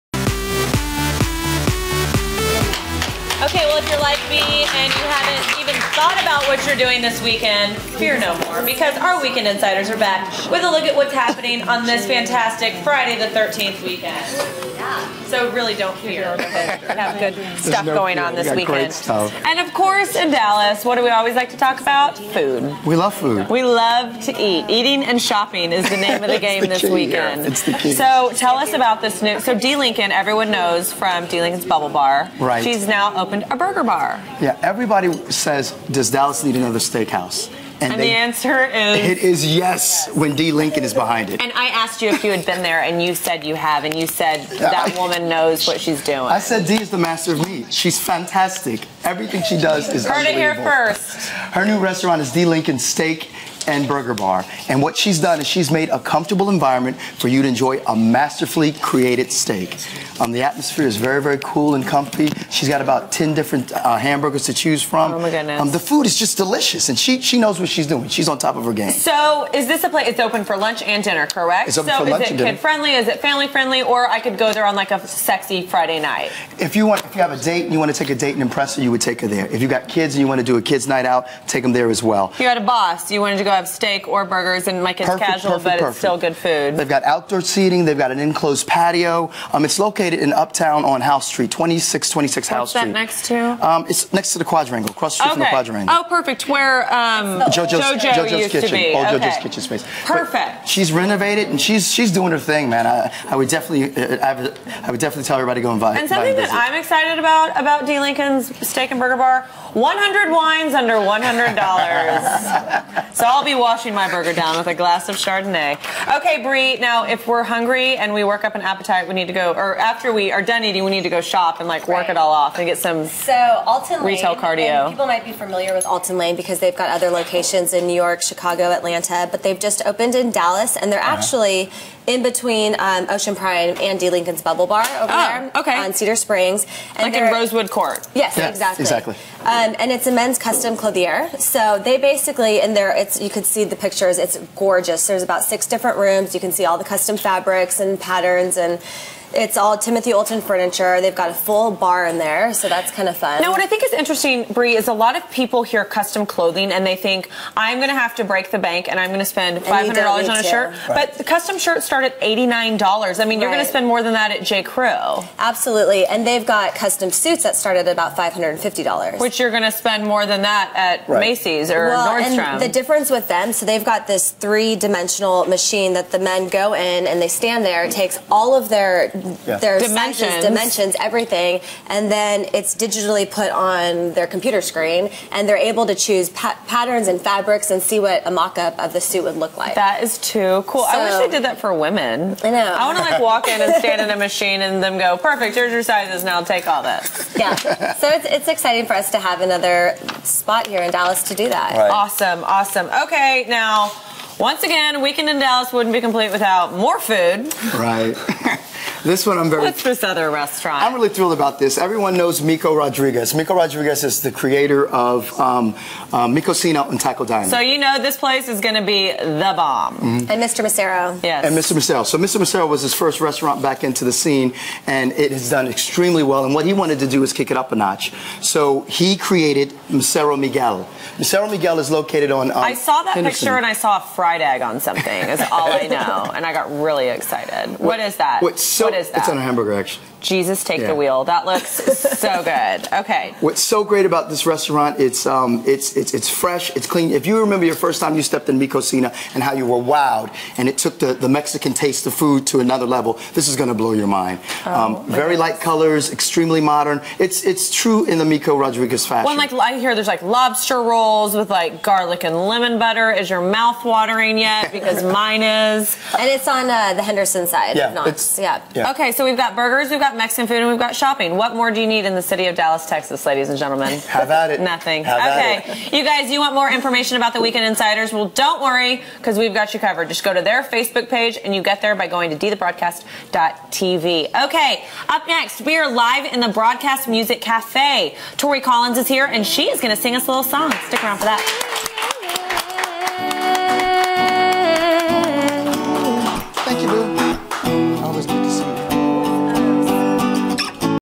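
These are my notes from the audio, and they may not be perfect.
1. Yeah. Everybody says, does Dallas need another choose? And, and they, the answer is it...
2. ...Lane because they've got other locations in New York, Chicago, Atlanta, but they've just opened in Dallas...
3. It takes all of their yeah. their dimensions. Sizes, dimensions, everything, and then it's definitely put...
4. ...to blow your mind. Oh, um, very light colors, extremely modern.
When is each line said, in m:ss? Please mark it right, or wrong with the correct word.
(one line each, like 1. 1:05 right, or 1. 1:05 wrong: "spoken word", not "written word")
1. 0:34 wrong: "steakhouse", not "choose"
2. 2:06 right
3. 2:57 wrong: "digitally", not "definitely"
4. 4:13 right.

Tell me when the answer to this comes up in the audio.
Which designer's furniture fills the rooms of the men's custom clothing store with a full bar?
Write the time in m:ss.
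2:29.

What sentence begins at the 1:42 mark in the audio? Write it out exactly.
I, I would definitely uh, I would, I would definitely tell everybody to go and buy.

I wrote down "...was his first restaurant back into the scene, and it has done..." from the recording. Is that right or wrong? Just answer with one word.
right.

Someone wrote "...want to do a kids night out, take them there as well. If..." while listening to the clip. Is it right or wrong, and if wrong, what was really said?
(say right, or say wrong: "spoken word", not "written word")
right.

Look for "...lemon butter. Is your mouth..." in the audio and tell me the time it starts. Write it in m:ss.
4:22.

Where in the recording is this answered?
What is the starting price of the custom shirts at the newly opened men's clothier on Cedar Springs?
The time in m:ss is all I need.
2:42.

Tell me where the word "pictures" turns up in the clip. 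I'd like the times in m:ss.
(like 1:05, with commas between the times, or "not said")
2:23, 3:53.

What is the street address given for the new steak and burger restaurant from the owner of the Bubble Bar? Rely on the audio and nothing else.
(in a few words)
2626 Howell Street.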